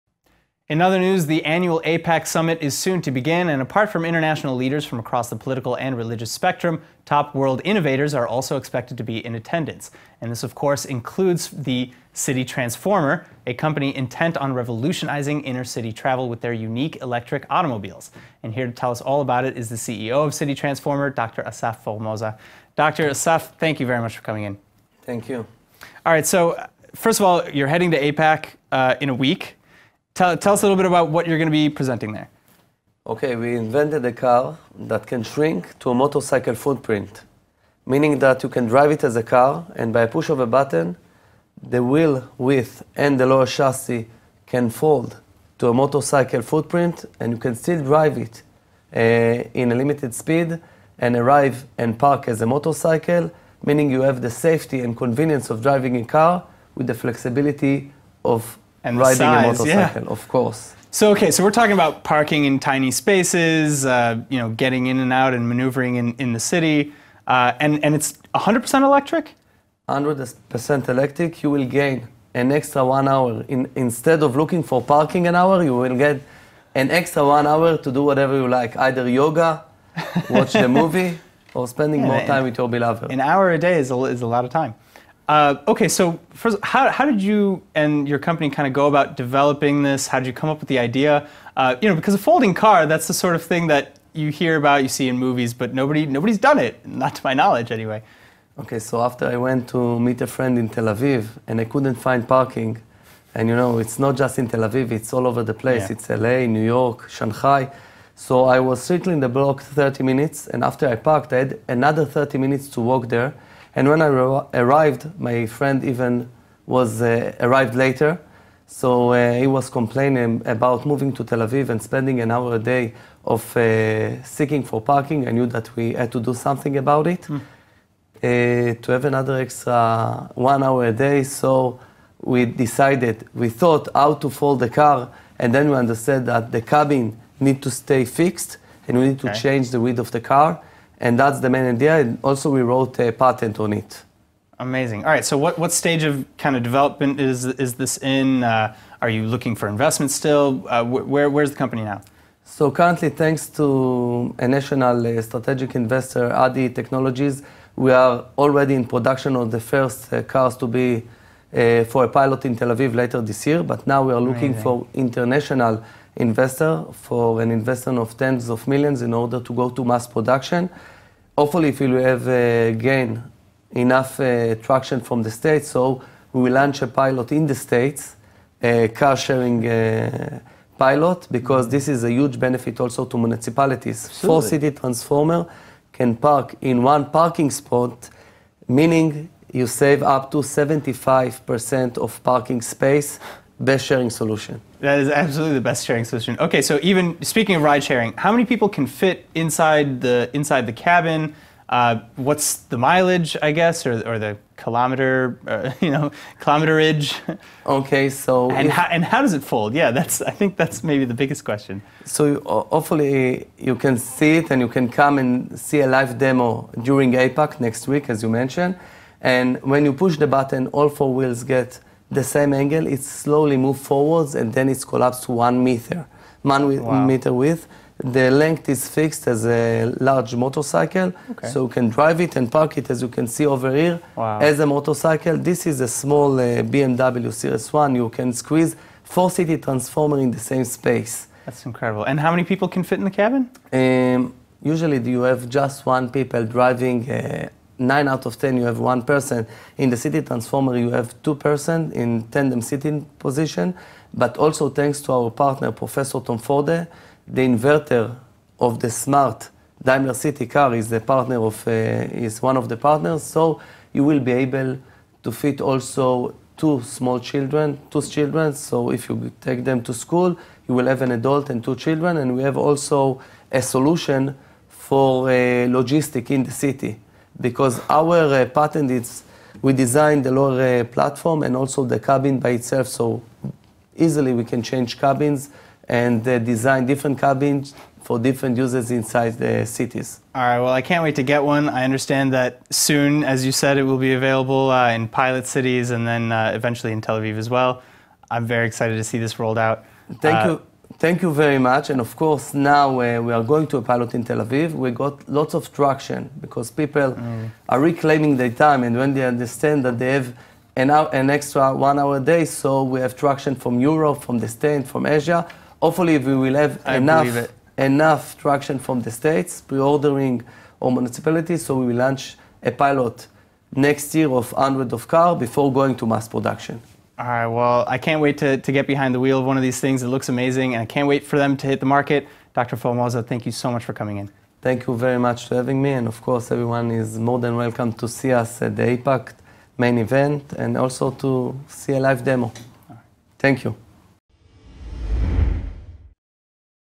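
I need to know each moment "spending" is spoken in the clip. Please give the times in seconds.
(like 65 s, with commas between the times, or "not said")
81 s, 121 s.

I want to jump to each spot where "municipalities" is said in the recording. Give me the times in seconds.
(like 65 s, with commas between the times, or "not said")
183 s, 320 s.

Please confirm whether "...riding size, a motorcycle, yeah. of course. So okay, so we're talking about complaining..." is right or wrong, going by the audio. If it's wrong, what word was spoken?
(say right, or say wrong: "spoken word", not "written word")
wrong: "parking", not "complaining".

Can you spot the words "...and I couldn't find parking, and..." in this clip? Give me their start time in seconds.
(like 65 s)
101 s.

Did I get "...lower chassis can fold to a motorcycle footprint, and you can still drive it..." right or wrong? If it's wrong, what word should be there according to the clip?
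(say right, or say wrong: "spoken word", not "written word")
right.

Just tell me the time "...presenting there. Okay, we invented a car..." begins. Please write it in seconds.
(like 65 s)
31 s.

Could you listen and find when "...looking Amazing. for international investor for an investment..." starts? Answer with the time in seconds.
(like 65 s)
164 s.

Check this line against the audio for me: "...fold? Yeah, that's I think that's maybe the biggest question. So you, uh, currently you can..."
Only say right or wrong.
wrong.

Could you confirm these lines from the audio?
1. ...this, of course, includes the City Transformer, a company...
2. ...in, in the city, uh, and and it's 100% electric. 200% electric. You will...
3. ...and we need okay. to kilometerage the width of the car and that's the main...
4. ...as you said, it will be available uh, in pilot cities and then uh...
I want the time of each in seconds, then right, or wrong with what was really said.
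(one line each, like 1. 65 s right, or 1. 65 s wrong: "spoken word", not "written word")
1. 10 s right
2. 65 s wrong: "100", not "200"
3. 138 s wrong: "change", not "kilometerage"
4. 293 s right.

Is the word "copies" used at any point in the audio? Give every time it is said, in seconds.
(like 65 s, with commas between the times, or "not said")
not said.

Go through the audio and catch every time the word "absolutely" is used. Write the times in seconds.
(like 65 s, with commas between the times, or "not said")
184 s, 195 s.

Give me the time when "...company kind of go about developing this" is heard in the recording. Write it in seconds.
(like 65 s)
88 s.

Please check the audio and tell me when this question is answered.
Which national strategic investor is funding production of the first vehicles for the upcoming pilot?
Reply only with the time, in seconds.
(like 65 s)
156 s.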